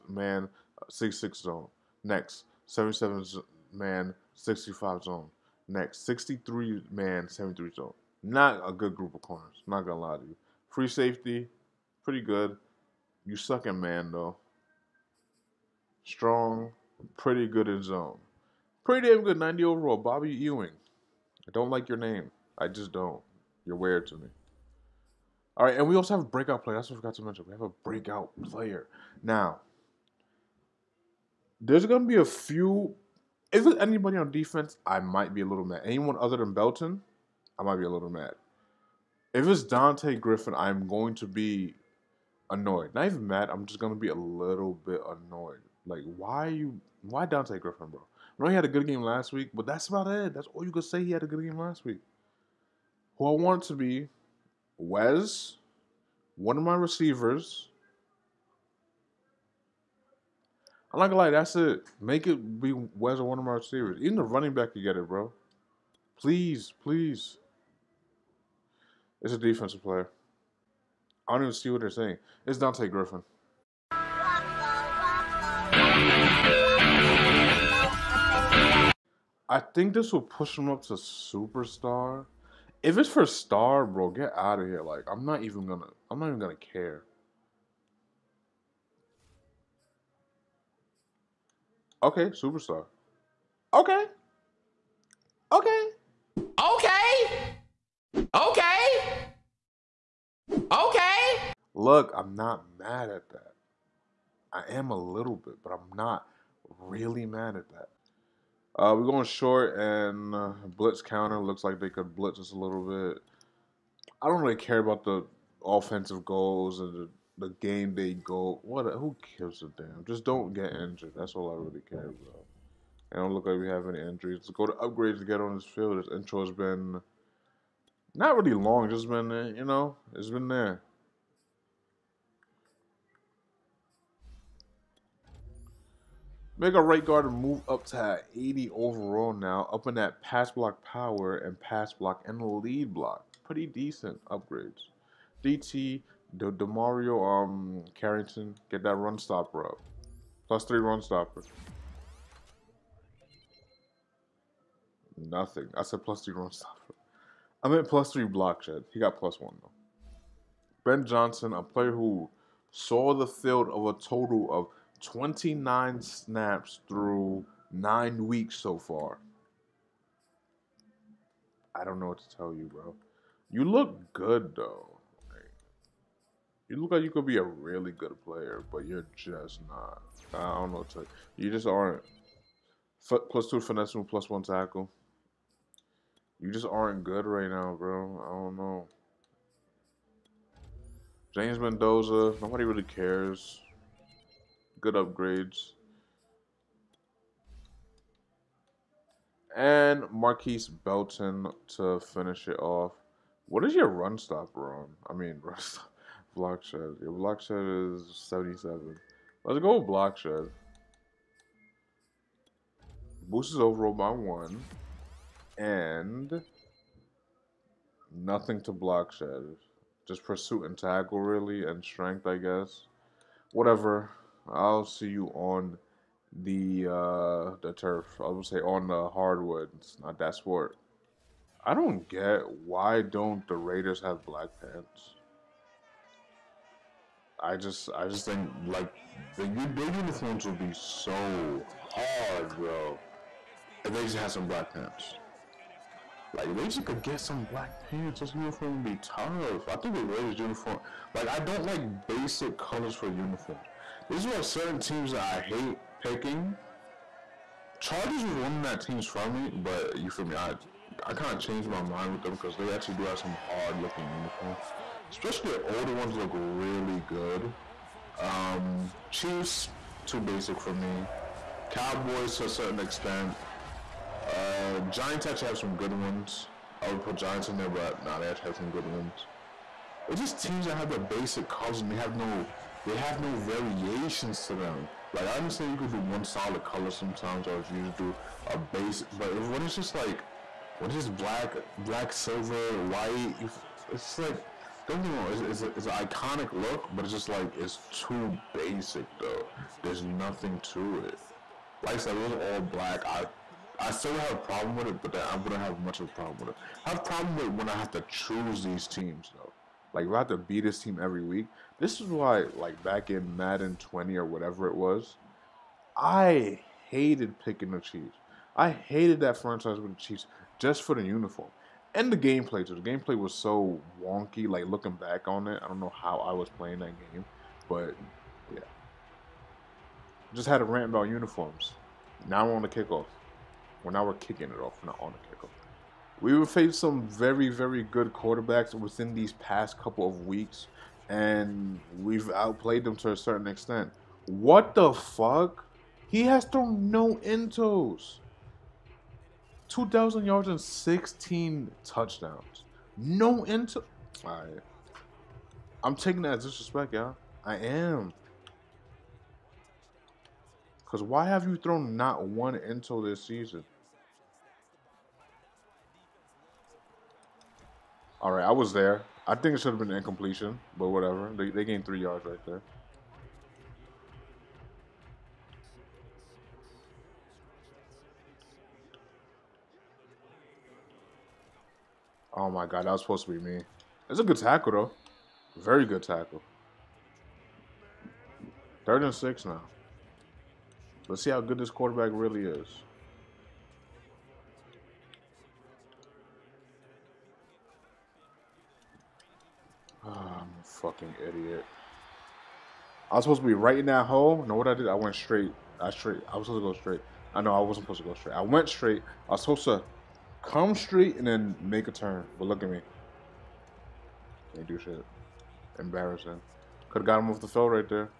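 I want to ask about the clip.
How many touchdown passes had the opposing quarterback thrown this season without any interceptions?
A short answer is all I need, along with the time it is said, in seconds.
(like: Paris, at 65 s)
16, at 350 s.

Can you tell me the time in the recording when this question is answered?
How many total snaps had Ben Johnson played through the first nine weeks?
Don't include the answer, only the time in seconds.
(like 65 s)
165 s.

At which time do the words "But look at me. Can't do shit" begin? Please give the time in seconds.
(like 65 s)
412 s.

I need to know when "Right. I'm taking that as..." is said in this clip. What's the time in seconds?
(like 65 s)
354 s.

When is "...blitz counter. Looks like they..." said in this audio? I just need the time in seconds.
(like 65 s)
110 s.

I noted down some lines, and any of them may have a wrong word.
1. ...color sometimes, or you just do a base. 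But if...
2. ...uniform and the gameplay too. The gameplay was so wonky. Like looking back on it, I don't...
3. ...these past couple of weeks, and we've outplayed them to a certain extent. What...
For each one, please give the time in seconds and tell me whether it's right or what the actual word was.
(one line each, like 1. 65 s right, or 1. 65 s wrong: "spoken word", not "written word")
1. 286 s right
2. 321 s right
3. 339 s right.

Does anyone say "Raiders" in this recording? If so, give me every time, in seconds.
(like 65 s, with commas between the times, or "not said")
233 s, 250 s.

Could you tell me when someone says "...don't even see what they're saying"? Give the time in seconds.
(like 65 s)
71 s.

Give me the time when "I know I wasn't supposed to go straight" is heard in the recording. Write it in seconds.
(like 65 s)
407 s.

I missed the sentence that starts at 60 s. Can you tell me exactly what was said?
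I'm not gonna lie, that's it.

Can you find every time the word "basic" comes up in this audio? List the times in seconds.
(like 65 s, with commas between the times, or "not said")
252 s, 270 s, 280 s, 298 s.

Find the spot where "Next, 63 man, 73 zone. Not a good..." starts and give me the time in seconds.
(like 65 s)
5 s.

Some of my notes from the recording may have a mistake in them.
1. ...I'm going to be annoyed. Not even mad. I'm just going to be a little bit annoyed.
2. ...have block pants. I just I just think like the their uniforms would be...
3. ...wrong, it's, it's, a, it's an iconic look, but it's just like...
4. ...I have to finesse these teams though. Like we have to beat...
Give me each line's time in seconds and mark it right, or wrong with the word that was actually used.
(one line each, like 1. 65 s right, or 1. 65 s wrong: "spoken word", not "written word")
1. 40 s right
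2. 233 s wrong: "black", not "block"
3. 295 s right
4. 307 s wrong: "choose", not "finesse".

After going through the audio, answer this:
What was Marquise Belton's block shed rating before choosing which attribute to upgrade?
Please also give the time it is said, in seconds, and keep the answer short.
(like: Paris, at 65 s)
77, at 206 s.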